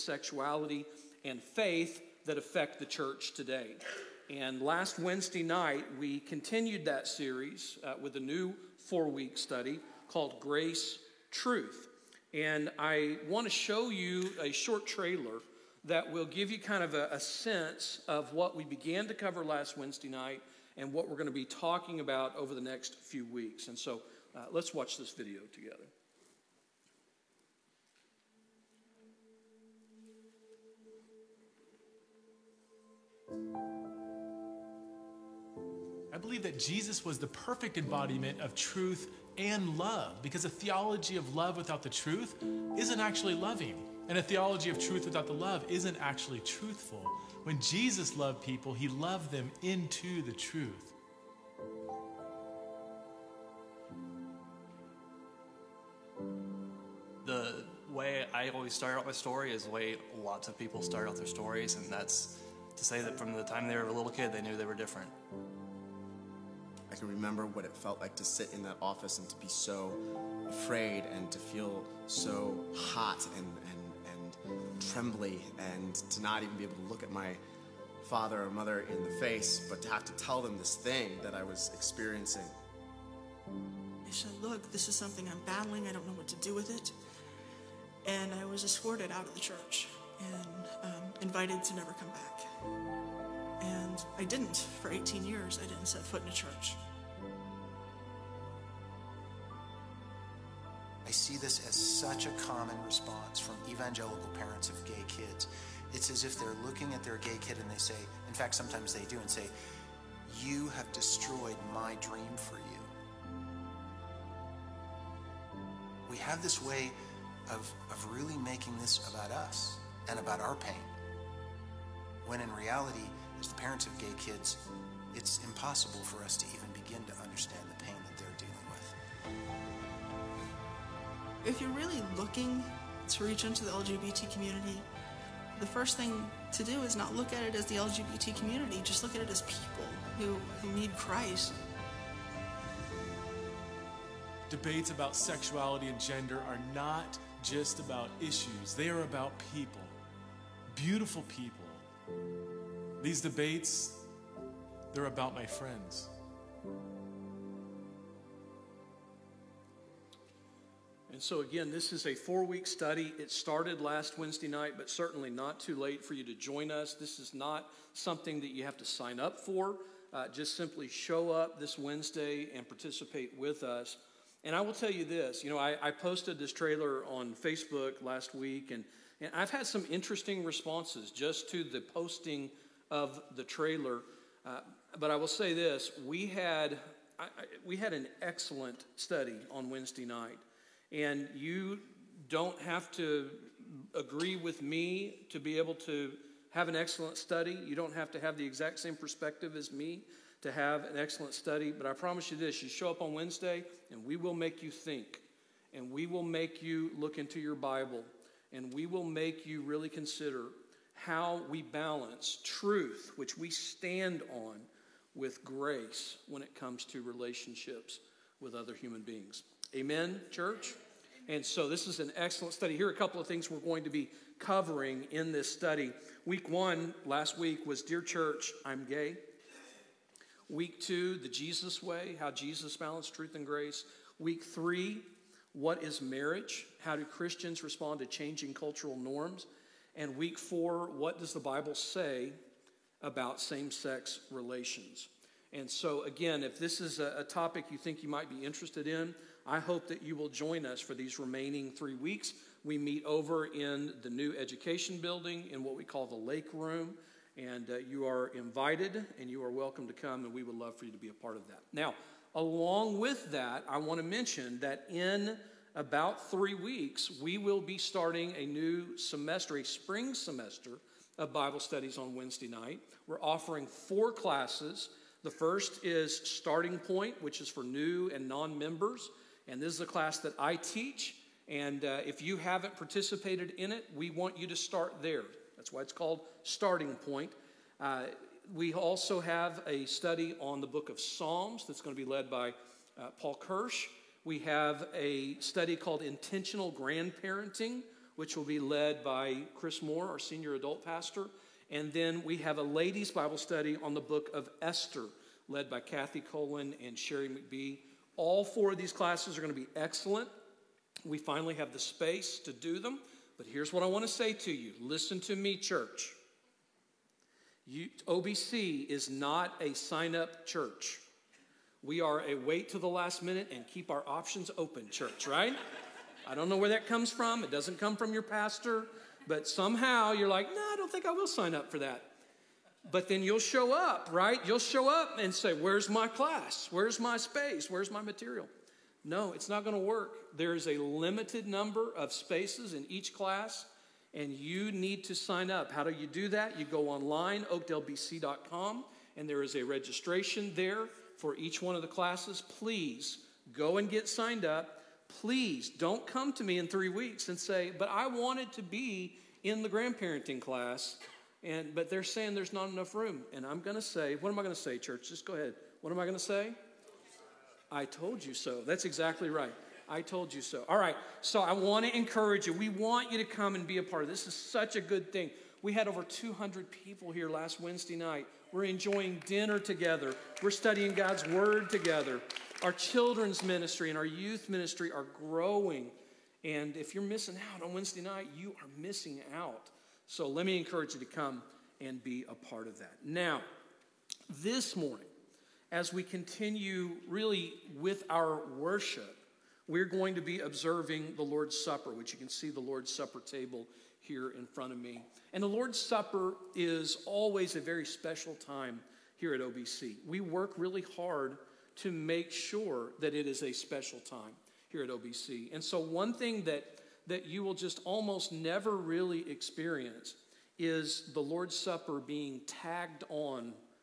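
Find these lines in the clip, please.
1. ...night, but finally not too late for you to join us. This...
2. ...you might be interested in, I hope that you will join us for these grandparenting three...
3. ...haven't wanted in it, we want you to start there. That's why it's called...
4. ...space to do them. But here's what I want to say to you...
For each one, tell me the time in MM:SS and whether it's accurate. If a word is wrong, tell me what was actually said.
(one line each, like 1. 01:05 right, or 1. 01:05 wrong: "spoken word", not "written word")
1. 02:44 wrong: "certainly", not "finally"
2. 04:08 wrong: "remaining", not "grandparenting"
3. 04:42 wrong: "participated", not "wanted"
4. 05:11 right.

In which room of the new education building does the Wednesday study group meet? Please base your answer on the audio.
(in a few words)
the lake room.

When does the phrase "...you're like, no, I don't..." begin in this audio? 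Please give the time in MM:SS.
05:30.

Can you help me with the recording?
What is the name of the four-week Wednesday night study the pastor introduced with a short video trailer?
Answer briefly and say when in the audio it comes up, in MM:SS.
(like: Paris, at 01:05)
Grace Truth, at 00:10.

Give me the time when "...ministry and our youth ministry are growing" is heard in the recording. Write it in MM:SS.
06:23.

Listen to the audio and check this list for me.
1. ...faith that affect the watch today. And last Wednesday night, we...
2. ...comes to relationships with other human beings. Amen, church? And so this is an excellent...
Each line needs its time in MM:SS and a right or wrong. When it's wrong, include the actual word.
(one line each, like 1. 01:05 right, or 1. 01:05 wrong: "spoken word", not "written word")
1. 00:01 wrong: "church", not "watch"
2. 03:36 right.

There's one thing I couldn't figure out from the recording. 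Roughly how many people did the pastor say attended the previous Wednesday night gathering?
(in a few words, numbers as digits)
over 200.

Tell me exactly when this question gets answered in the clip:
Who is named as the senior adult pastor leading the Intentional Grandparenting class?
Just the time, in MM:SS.
04:59.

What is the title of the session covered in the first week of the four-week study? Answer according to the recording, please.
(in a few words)
Dear Church, I'm Gay.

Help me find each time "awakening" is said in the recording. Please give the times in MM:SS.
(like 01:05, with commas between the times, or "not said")
not said.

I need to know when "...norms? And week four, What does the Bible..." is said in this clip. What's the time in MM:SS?
03:58.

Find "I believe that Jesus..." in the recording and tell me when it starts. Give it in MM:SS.
00:36.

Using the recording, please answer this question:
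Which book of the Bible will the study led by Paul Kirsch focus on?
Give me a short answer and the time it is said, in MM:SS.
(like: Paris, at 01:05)
Psalms, at 04:51.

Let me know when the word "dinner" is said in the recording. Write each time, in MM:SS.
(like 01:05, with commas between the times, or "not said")
06:19.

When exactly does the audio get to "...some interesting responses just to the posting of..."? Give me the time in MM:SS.
02:59.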